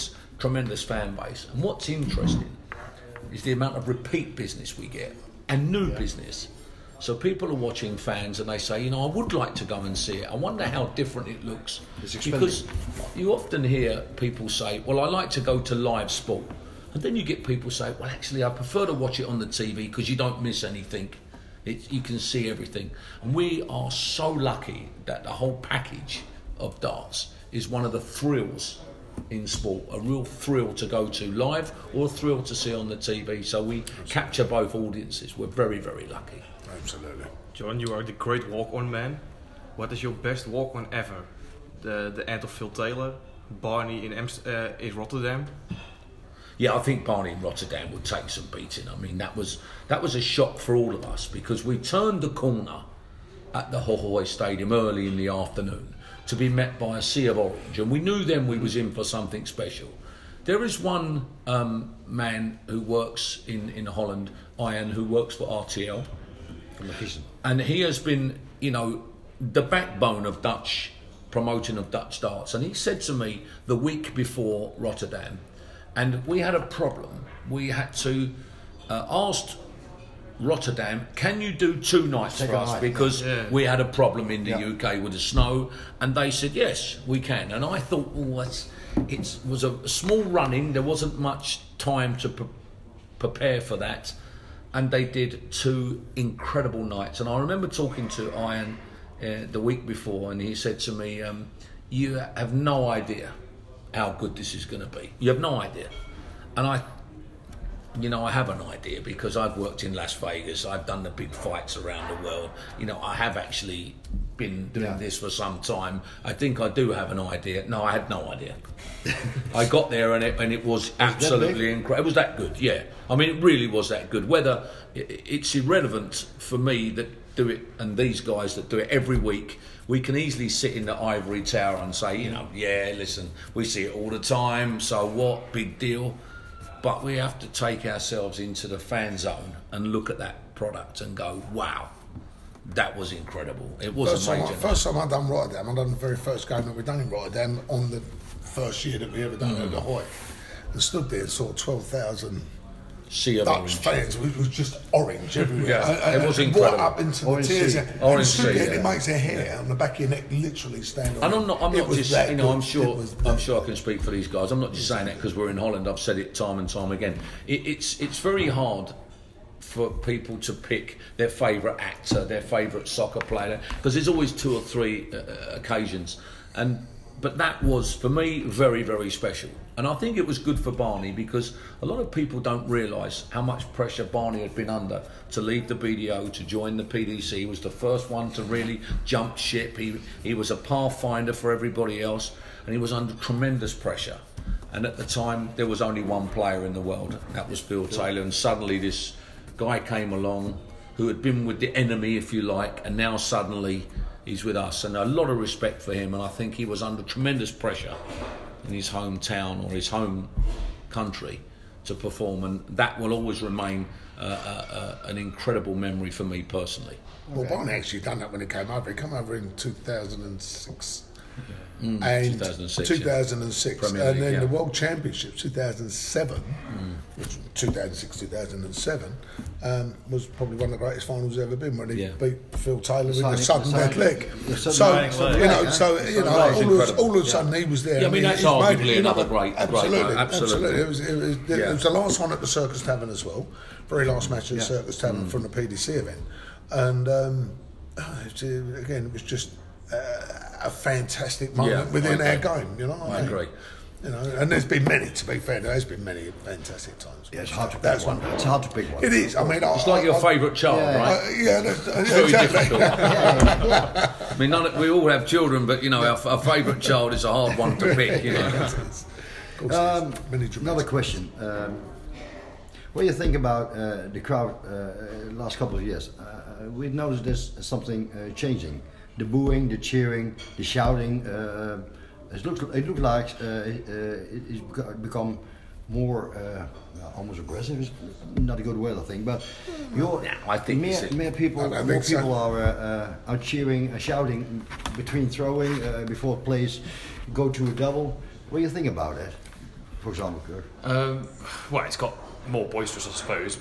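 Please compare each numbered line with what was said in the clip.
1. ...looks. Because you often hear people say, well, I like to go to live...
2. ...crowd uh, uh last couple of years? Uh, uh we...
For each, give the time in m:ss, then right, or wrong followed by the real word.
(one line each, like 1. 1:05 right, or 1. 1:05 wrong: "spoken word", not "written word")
1. 0:11 right
2. 4:34 right.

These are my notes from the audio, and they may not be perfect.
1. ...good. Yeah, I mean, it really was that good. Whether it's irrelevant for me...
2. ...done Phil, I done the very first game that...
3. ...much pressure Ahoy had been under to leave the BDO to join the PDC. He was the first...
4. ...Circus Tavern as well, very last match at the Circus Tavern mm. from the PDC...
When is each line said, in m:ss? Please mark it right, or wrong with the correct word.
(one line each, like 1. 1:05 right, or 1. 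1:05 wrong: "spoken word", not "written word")
1. 2:02 right
2. 2:25 wrong: "Rotterdam", not "Phil"
3. 3:03 wrong: "Barney", not "Ahoy"
4. 4:02 right.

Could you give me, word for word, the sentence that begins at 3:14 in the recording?
And at the time, there was only one player in the world, that was Phil Taylor.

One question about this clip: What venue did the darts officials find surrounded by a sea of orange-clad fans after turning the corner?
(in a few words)
Ahoy Stadium.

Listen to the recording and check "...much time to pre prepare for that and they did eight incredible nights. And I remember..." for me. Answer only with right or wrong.
wrong.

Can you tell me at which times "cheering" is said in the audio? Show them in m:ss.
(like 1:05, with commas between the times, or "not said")
4:39, 4:53.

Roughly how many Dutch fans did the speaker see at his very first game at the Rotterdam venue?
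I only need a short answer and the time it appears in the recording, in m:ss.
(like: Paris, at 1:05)
12,000, at 2:31.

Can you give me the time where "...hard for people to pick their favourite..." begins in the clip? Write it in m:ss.
2:48.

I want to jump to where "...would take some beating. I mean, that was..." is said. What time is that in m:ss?
0:47.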